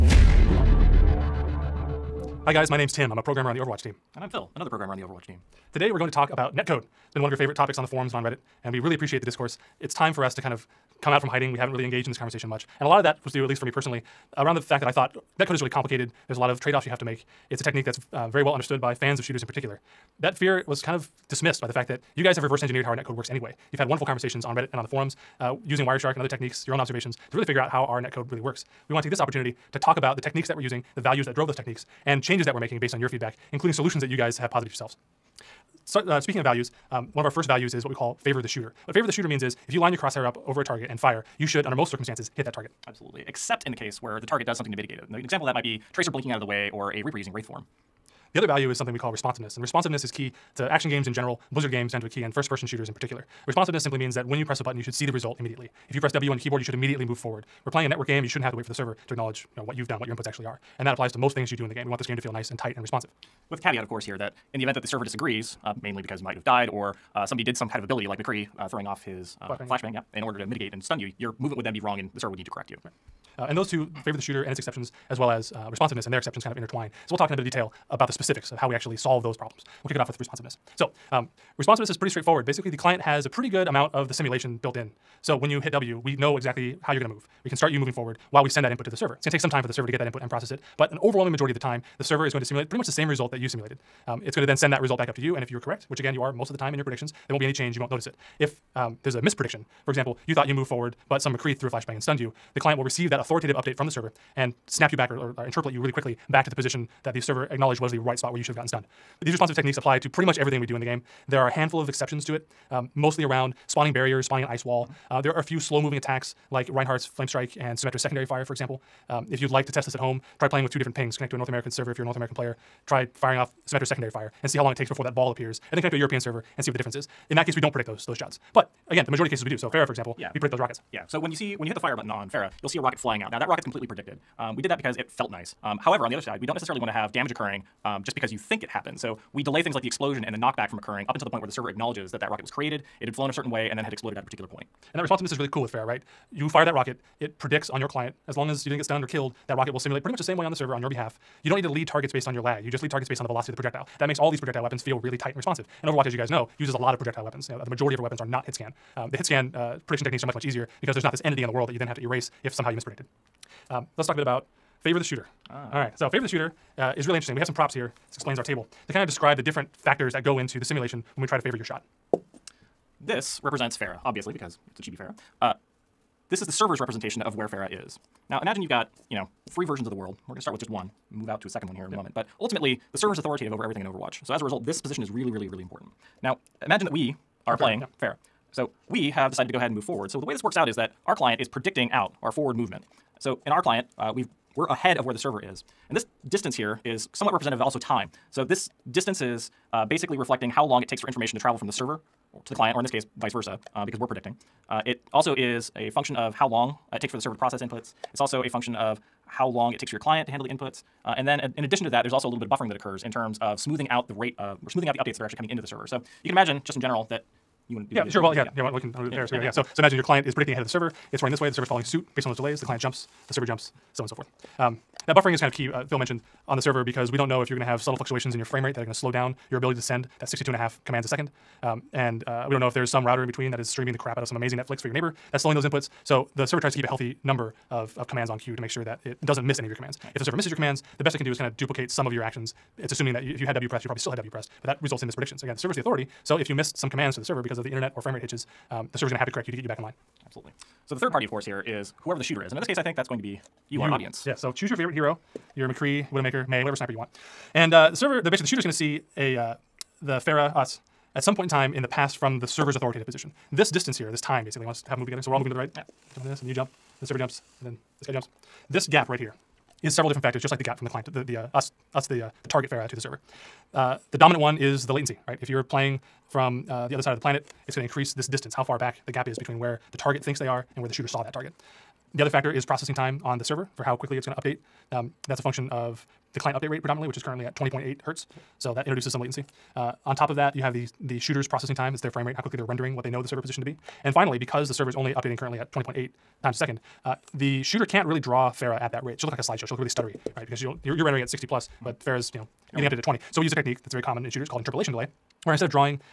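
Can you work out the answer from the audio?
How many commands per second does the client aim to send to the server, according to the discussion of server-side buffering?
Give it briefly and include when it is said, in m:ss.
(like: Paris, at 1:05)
62.5, at 3:50.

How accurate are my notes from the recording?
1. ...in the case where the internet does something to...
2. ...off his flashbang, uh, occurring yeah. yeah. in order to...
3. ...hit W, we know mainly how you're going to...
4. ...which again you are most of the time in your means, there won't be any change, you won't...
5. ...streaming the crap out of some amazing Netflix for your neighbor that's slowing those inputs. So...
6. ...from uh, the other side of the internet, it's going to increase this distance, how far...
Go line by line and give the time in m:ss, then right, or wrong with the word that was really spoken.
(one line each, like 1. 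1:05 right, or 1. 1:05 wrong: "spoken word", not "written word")
1. 0:43 wrong: "target", not "internet"
2. 1:08 wrong: "flashbang", not "occurring"
3. 1:25 wrong: "exactly", not "mainly"
4. 1:35 wrong: "predictions", not "means"
5. 3:53 right
6. 4:36 wrong: "planet", not "internet".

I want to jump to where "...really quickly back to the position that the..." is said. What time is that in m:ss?
1:45.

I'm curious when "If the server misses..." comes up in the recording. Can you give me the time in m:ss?
4:00.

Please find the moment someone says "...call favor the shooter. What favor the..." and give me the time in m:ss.
0:37.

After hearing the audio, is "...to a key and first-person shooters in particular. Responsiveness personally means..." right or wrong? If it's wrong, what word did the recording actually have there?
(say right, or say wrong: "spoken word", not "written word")
wrong: "simply", not "personally".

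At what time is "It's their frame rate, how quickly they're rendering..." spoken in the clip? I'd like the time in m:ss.
4:51.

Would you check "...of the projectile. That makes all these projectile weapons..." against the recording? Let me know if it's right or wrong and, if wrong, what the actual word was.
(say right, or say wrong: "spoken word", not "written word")
right.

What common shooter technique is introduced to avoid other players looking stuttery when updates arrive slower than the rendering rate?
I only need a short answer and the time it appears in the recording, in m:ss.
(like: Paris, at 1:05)
interpolation delay, at 5:04.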